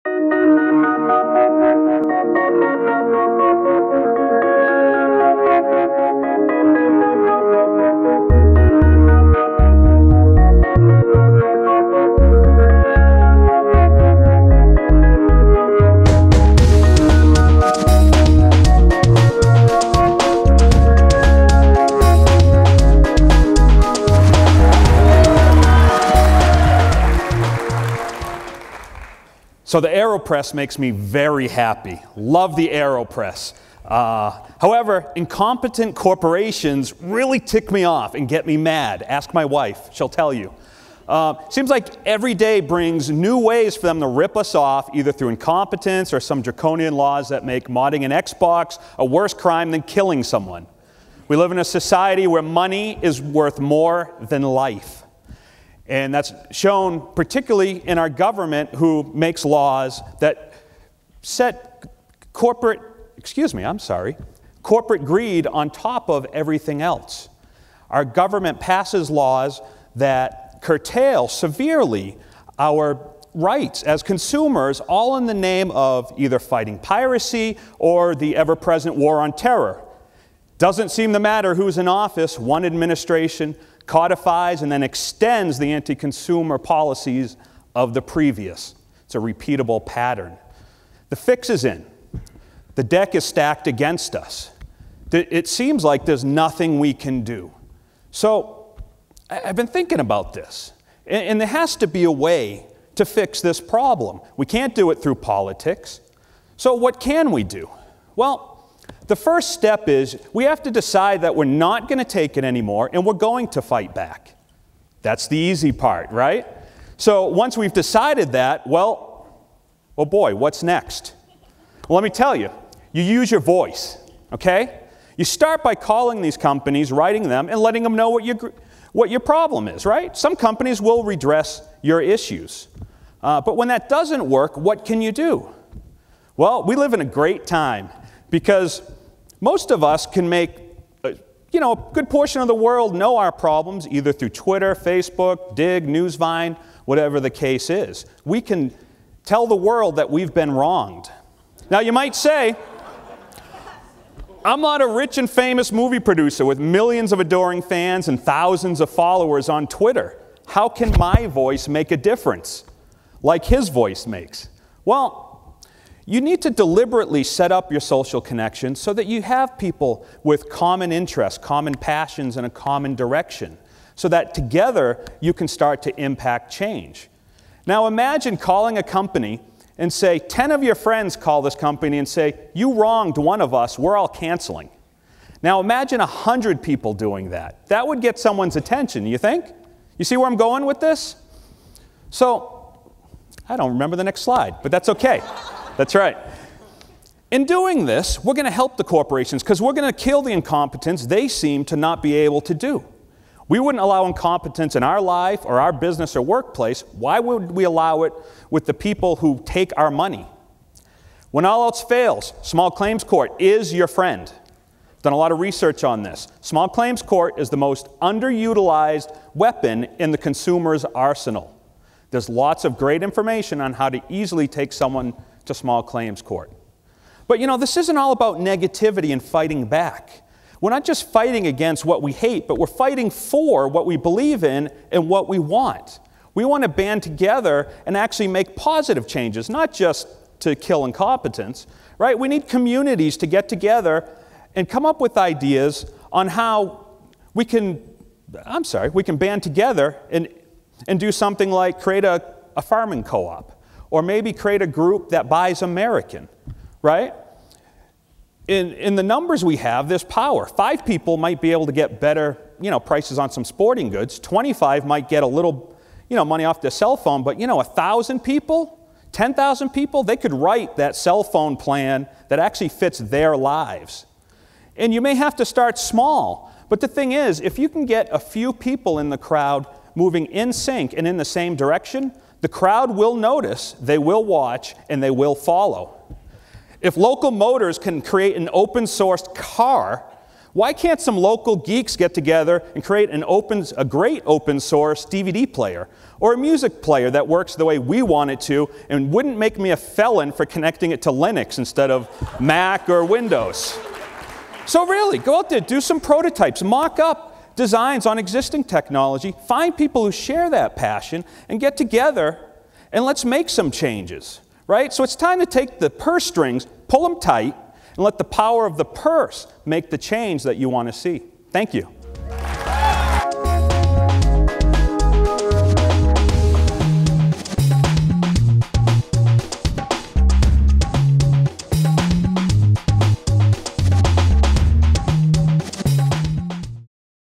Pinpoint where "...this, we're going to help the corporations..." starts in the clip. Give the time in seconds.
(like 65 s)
197 s.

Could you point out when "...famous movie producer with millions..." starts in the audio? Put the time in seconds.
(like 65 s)
155 s.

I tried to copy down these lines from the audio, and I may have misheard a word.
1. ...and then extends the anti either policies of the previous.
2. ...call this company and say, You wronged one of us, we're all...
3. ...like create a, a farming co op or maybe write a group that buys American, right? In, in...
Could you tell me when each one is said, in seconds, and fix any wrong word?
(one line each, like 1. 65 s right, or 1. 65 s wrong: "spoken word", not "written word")
1. 84 s wrong: "consumer", not "either"
2. 181 s right
3. 251 s wrong: "create", not "write".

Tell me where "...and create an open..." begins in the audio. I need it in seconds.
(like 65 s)
292 s.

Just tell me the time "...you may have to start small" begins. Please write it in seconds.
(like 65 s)
274 s.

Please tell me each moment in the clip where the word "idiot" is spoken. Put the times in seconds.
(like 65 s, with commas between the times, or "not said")
not said.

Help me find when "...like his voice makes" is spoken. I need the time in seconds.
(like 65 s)
163 s.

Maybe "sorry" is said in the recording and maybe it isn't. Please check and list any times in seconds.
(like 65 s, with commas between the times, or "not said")
63 s, 248 s.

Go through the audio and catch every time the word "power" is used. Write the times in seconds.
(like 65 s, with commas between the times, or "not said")
260 s, 318 s.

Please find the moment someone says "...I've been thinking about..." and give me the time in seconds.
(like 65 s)
99 s.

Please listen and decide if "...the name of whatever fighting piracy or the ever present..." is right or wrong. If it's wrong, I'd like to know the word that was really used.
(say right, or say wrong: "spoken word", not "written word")
wrong: "either", not "whatever".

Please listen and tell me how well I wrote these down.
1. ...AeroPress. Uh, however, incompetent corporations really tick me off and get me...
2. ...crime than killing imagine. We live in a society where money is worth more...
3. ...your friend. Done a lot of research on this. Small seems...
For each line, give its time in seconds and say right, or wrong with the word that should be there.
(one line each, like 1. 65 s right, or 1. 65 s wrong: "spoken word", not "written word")
1. 32 s right
2. 49 s wrong: "someone", not "imagine"
3. 213 s wrong: "claims", not "seems".